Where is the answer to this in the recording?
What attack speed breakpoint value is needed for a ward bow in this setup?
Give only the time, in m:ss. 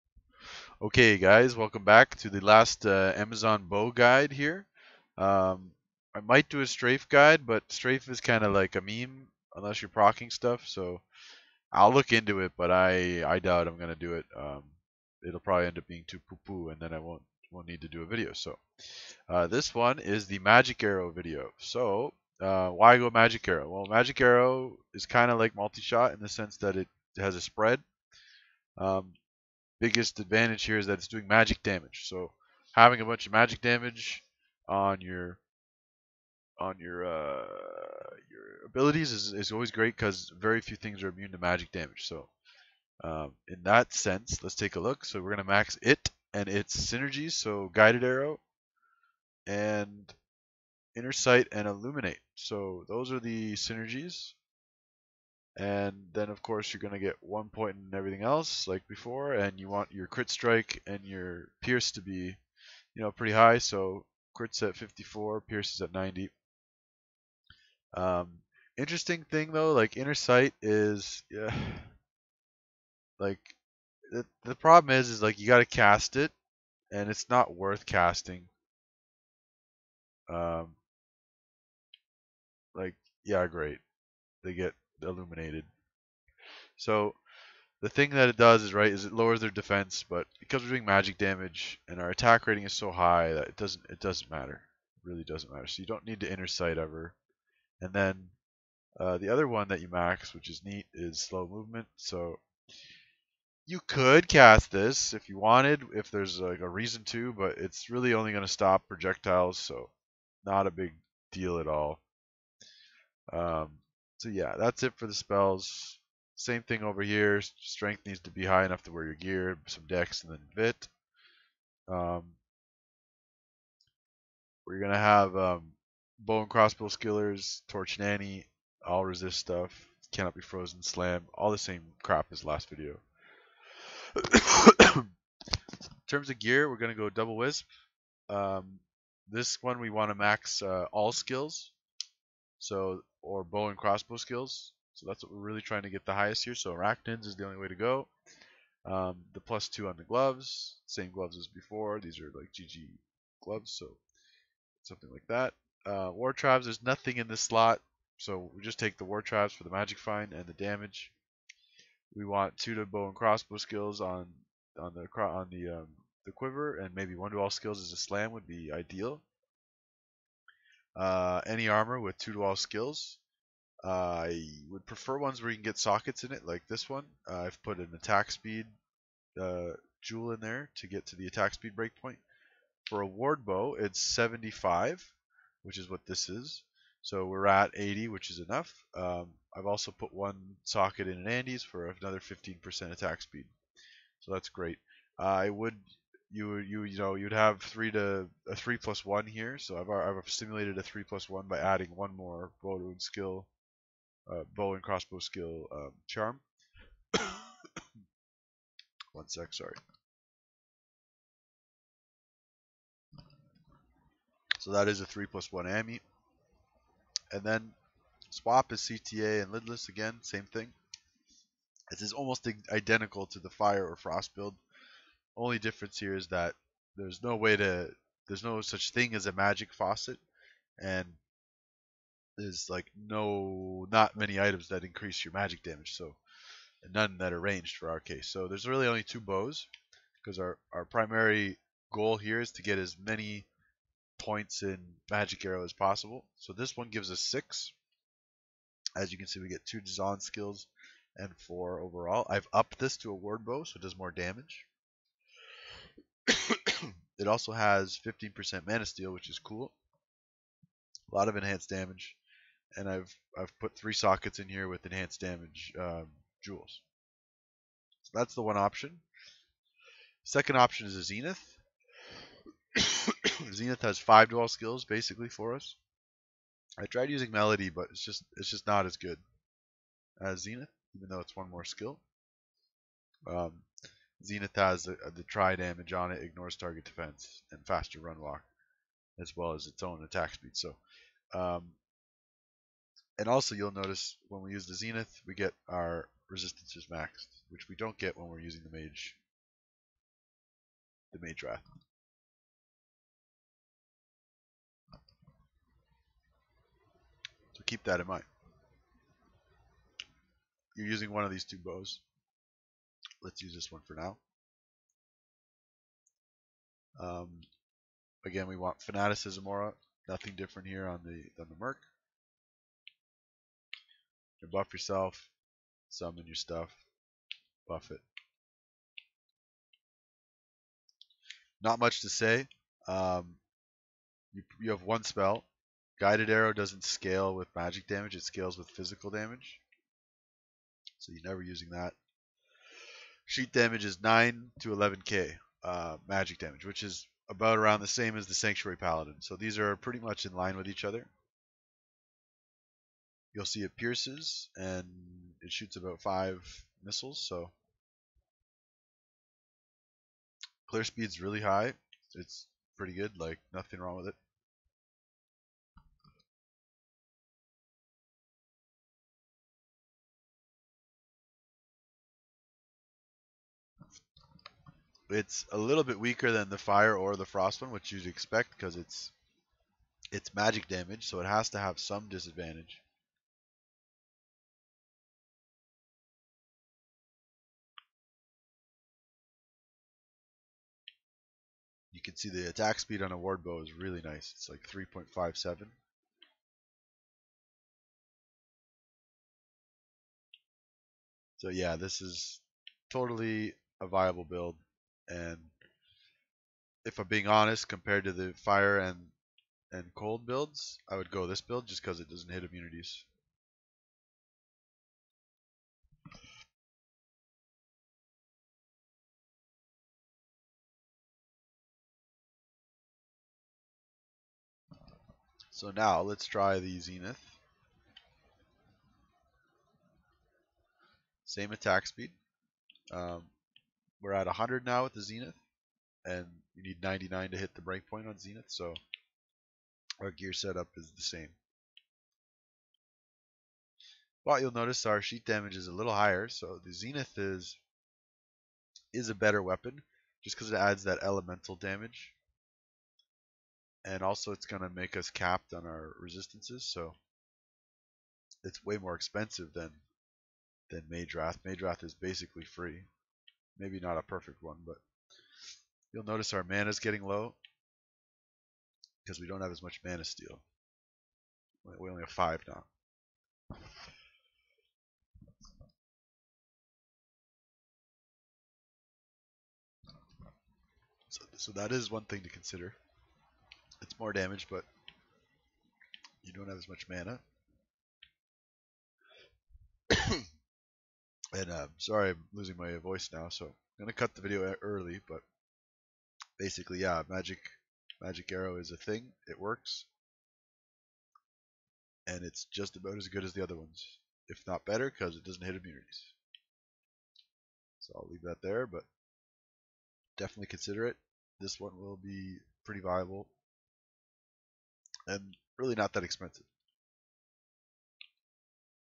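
3:03.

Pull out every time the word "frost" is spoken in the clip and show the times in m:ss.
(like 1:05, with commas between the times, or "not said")
3:43, 6:17.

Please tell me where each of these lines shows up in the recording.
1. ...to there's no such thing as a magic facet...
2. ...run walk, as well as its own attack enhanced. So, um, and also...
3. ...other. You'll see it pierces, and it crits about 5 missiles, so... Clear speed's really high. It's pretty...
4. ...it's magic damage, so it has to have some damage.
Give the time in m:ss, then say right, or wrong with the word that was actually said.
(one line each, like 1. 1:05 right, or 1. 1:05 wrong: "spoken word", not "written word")
1. 3:47 right
2. 4:47 wrong: "speed", not "enhanced"
3. 5:50 wrong: "shoots", not "crits"
4. 6:20 wrong: "disadvantage", not "damage".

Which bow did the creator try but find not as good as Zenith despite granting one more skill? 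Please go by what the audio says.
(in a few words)
Melody.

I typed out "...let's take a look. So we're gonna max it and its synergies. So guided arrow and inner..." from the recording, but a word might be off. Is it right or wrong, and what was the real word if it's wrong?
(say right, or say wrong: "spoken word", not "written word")
right.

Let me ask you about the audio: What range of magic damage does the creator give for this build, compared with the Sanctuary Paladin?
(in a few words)
9 to 11k.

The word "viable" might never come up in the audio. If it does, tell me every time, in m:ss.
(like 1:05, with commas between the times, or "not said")
6:43, 8:32.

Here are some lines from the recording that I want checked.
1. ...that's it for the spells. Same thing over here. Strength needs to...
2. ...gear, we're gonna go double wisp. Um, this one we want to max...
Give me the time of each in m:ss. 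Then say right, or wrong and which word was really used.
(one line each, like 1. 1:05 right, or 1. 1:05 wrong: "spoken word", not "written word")
1. 1:54 right
2. 2:16 right.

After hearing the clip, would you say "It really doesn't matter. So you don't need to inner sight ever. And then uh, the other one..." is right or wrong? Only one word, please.
right.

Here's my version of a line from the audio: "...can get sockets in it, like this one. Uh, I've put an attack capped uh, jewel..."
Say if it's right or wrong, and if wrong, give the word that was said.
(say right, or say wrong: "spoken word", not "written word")
wrong: "speed", not "capped".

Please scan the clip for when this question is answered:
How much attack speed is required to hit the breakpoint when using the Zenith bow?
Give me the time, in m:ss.
7:16.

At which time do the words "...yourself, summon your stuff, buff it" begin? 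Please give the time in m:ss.
5:24.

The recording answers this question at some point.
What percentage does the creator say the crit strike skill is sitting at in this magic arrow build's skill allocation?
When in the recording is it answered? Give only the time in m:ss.
1:04.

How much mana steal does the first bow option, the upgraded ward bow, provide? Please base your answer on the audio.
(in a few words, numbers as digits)
15%.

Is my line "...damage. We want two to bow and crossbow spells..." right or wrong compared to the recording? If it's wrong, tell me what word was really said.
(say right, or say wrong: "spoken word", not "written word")
wrong: "skills", not "spells".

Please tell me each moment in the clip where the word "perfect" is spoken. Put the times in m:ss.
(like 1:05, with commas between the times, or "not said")
7:44.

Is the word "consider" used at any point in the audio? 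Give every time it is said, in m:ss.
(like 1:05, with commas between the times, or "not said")
8:02, 8:30.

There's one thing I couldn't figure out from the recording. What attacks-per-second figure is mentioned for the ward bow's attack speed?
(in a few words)
3.57.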